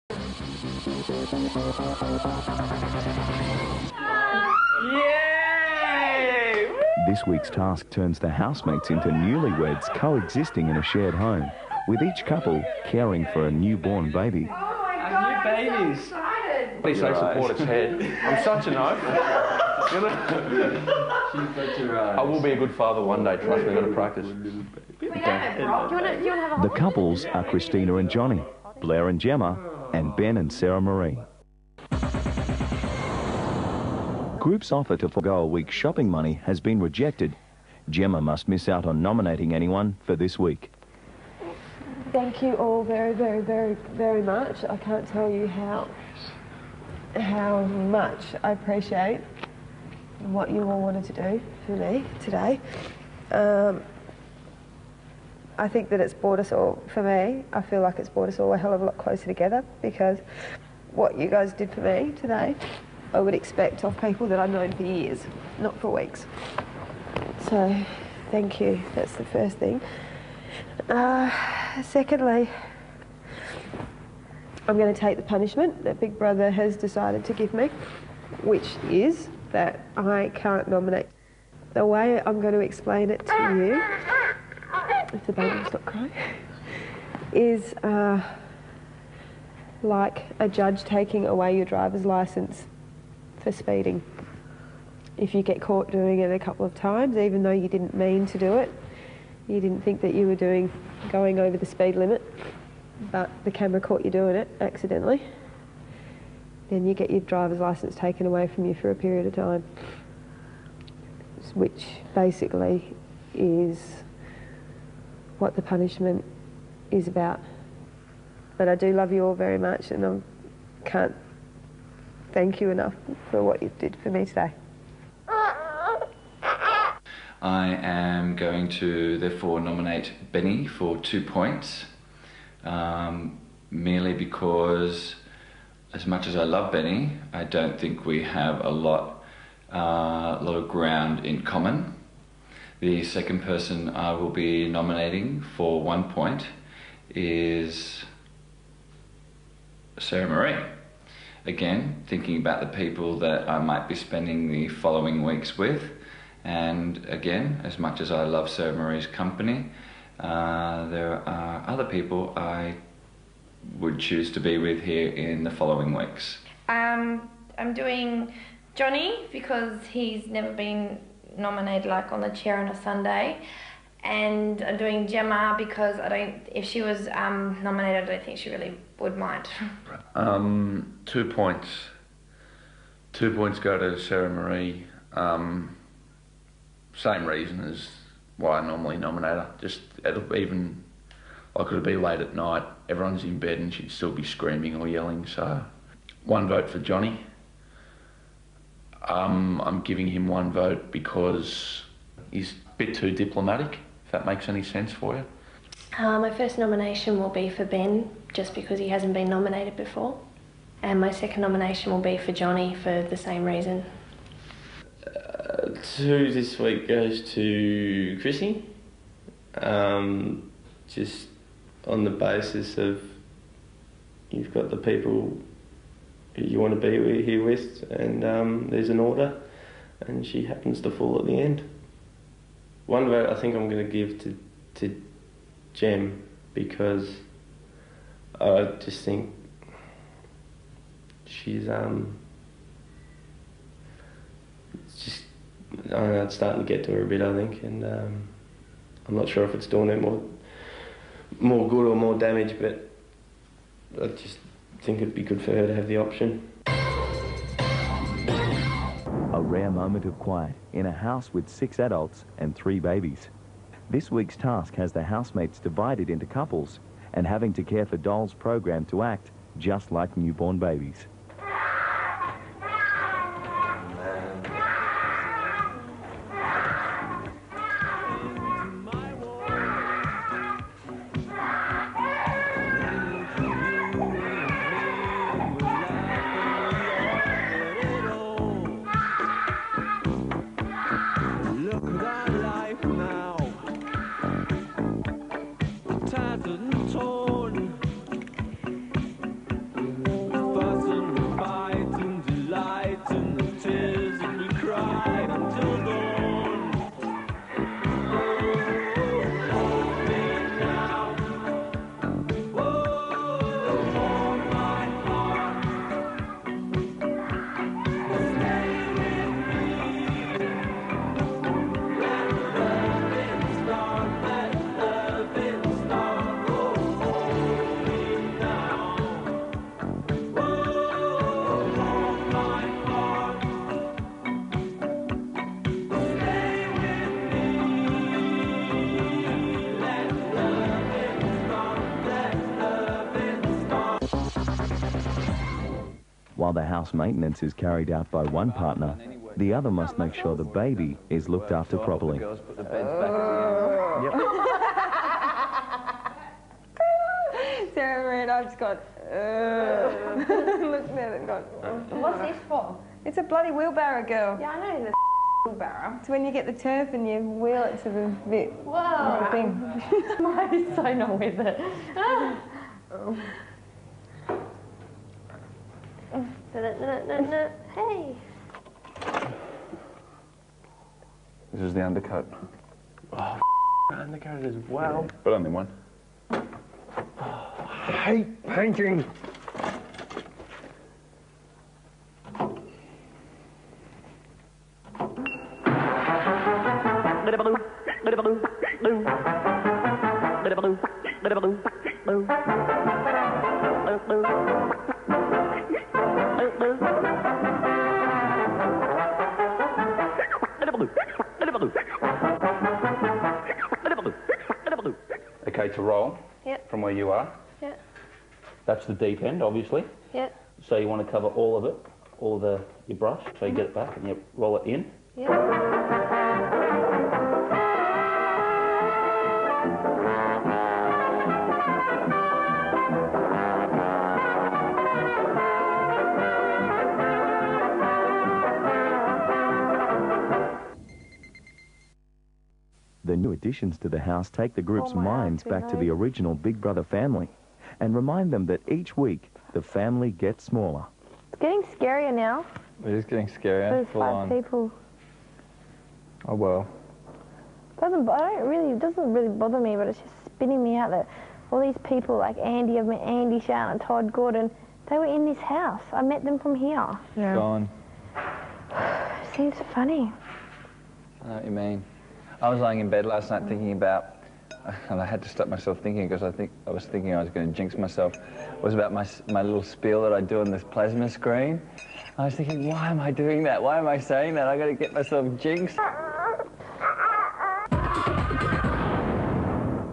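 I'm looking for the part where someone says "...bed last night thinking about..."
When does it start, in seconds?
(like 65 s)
472 s.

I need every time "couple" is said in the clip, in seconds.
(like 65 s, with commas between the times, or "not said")
12 s, 26 s, 96 s, 266 s.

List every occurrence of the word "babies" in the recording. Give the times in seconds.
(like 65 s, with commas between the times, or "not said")
262 s, 270 s.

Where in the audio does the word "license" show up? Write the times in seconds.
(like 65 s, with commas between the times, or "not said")
92 s, 107 s.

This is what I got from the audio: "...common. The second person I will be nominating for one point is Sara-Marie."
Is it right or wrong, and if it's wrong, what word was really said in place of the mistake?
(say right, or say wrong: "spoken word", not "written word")
right.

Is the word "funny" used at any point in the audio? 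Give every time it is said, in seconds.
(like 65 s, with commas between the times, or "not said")
469 s.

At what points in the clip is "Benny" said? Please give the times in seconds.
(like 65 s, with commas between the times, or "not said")
130 s, 136 s.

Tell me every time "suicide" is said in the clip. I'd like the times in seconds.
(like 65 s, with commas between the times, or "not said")
not said.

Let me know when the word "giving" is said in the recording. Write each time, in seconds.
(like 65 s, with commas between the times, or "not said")
199 s.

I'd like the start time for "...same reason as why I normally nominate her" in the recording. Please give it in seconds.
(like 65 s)
186 s.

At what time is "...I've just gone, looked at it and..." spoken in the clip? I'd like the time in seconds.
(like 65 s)
358 s.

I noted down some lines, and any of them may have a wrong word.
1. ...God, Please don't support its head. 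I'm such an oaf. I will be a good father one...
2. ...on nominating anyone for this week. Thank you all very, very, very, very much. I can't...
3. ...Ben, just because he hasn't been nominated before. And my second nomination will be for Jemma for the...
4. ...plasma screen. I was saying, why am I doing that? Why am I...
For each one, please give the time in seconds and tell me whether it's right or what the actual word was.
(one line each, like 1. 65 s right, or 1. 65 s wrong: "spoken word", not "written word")
1. 15 s right
2. 38 s right
3. 207 s wrong: "Johnny", not "Jemma"
4. 480 s wrong: "thinking", not "saying".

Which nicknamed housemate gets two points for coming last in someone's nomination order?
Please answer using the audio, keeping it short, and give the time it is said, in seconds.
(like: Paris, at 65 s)
Chrissy, at 218 s.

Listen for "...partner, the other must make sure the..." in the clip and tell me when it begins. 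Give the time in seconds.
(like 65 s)
348 s.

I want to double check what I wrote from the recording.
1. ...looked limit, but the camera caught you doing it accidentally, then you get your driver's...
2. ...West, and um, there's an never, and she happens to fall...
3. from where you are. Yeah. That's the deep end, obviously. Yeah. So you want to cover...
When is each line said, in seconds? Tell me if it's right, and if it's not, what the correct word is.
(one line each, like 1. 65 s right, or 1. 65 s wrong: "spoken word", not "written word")
1. 101 s wrong: "speed", not "looked"
2. 227 s wrong: "order", not "never"
3. 416 s right.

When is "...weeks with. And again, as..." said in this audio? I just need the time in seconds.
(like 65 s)
155 s.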